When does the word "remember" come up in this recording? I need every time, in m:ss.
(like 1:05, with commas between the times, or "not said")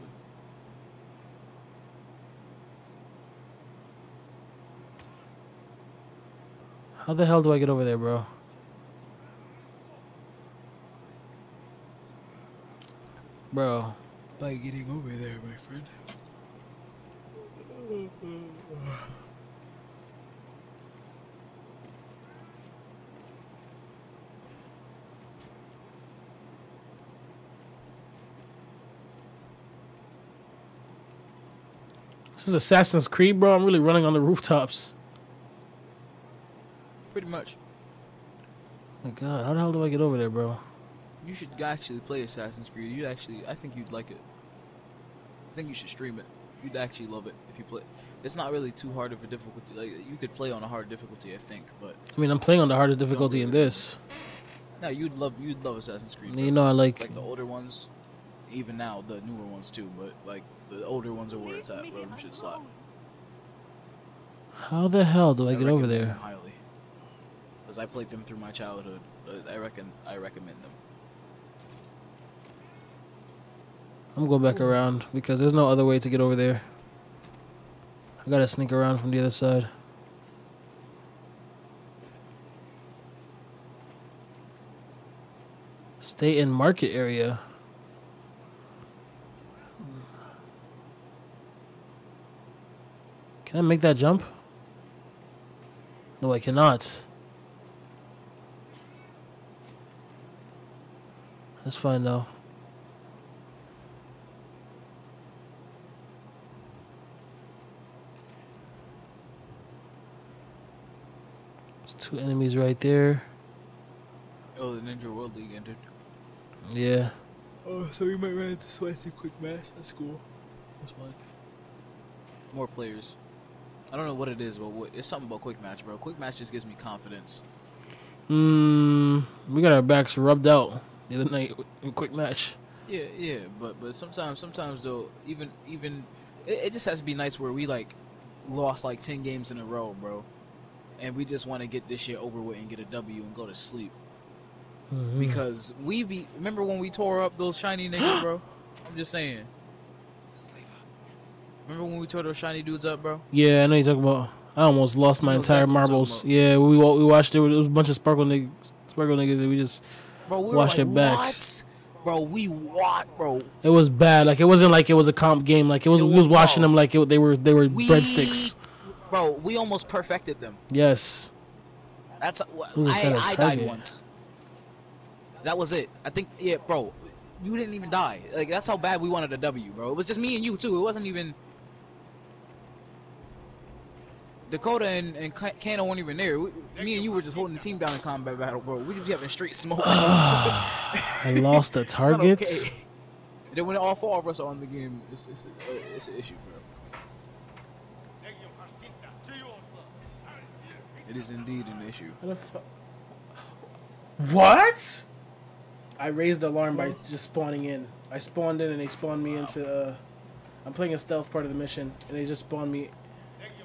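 2:26, 2:31.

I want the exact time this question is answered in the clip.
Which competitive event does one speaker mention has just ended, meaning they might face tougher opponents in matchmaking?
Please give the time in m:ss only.
1:54.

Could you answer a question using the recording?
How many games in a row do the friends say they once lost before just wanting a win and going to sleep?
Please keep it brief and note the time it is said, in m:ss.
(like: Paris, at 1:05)
10, at 2:19.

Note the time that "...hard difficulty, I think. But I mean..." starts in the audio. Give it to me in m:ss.
0:50.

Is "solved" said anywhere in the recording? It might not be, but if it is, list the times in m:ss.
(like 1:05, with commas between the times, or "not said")
not said.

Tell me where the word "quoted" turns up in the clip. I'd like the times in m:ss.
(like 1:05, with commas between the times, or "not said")
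not said.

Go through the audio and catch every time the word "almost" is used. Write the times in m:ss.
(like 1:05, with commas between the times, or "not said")
2:34, 2:49.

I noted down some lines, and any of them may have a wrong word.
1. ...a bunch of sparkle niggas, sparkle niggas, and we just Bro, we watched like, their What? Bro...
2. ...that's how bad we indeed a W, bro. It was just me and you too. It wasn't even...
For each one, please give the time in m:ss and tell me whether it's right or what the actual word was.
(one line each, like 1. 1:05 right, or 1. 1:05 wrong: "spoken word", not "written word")
1. 2:37 right
2. 2:58 wrong: "wanted", not "indeed".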